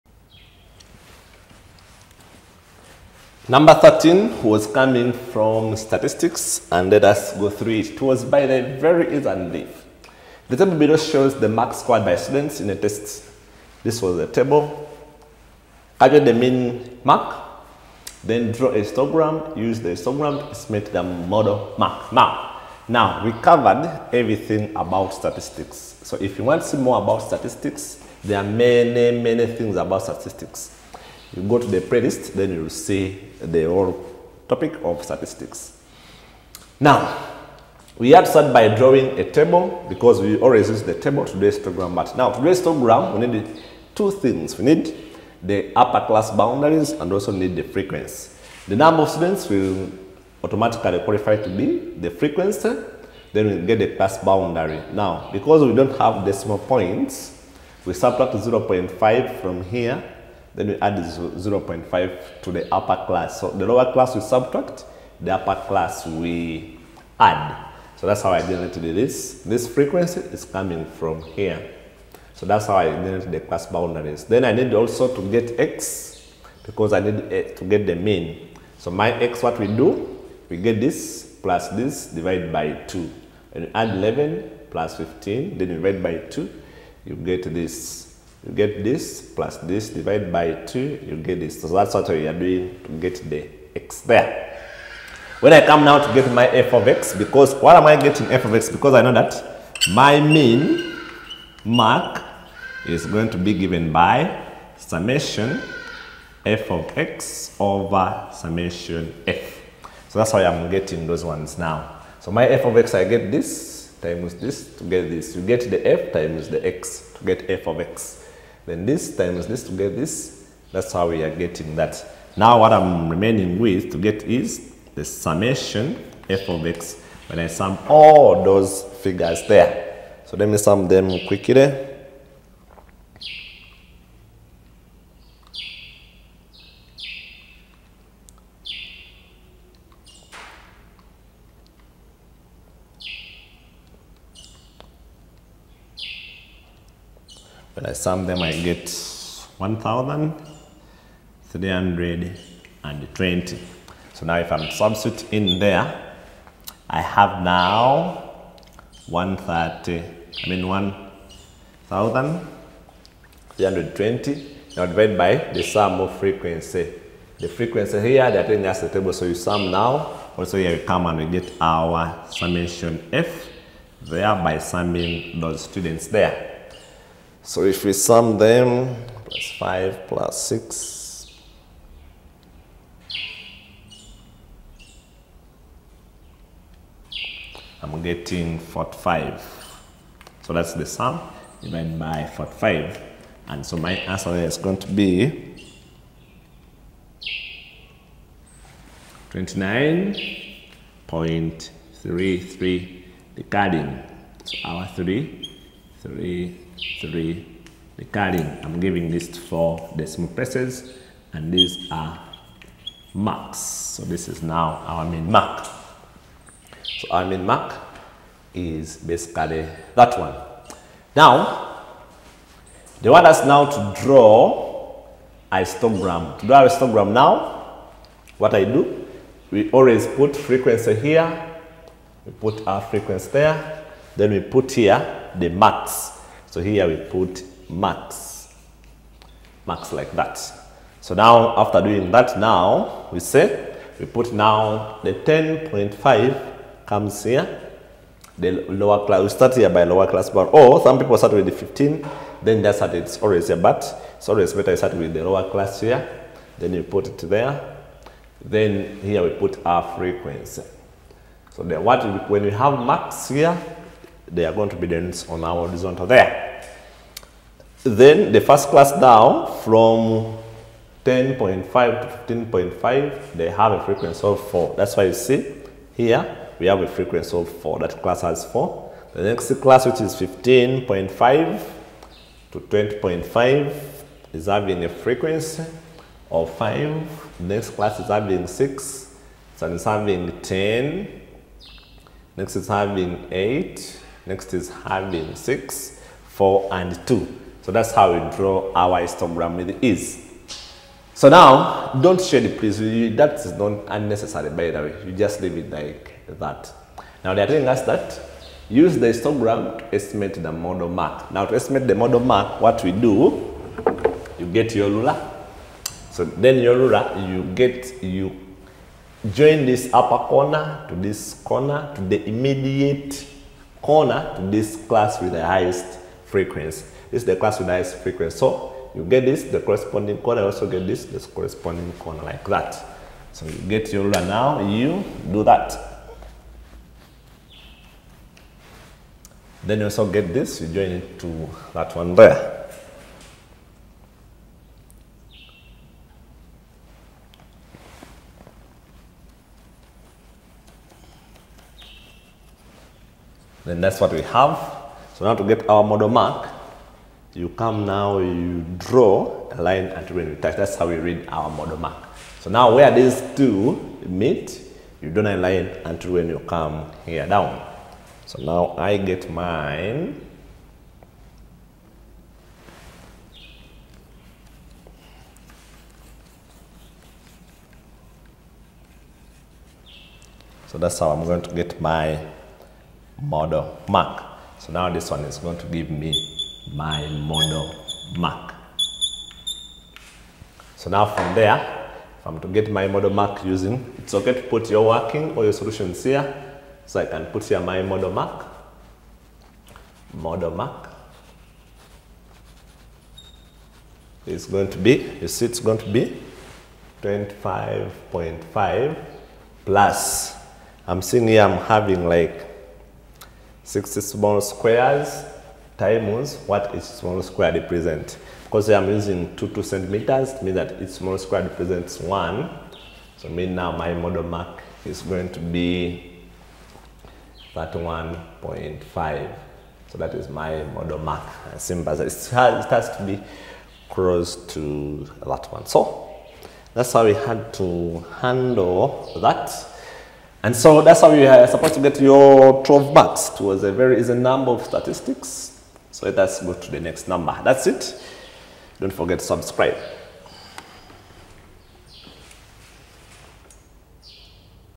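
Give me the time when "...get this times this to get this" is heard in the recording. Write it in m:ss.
1:53.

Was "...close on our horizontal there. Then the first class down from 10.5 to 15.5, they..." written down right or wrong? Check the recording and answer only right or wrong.
wrong.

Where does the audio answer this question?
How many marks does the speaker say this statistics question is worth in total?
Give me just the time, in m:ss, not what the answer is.
7:22.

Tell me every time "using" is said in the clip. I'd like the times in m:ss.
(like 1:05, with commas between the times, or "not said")
6:33, 6:58.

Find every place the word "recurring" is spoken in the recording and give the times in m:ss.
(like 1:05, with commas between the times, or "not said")
3:27.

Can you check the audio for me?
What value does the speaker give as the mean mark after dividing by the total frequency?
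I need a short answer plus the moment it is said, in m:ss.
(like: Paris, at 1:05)
29.33, at 3:19.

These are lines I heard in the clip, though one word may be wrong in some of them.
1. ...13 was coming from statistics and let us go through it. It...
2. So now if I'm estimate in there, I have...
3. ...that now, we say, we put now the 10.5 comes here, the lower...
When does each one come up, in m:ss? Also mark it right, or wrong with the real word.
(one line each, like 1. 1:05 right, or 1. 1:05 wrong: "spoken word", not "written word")
1. 0:03 right
2. 2:34 wrong: "substitute", not "estimate"
3. 4:02 right.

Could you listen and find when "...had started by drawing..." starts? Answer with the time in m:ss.
0:38.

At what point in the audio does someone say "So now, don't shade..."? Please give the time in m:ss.
5:01.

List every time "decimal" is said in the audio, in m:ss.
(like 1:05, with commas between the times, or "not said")
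0:56, 3:29.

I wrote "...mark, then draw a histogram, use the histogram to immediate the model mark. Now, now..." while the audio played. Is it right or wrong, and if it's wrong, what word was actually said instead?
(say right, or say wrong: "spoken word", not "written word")
wrong: "estimate", not "immediate".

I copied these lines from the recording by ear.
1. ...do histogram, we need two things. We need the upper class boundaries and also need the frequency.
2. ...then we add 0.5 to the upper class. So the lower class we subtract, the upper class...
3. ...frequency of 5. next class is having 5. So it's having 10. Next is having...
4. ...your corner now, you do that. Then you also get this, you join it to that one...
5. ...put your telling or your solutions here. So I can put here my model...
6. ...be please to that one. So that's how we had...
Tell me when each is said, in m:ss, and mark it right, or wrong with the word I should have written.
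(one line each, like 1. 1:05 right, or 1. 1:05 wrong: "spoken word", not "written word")
1. 0:42 right
2. 1:00 right
3. 4:44 wrong: "6", not "5"
4. 5:33 wrong: "ruler", not "corner"
5. 6:34 wrong: "working", not "telling"
6. 7:13 wrong: "close", not "please".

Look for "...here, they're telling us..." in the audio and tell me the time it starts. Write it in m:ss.
2:48.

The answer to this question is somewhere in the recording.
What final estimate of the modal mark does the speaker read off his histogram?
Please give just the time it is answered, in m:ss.
7:07.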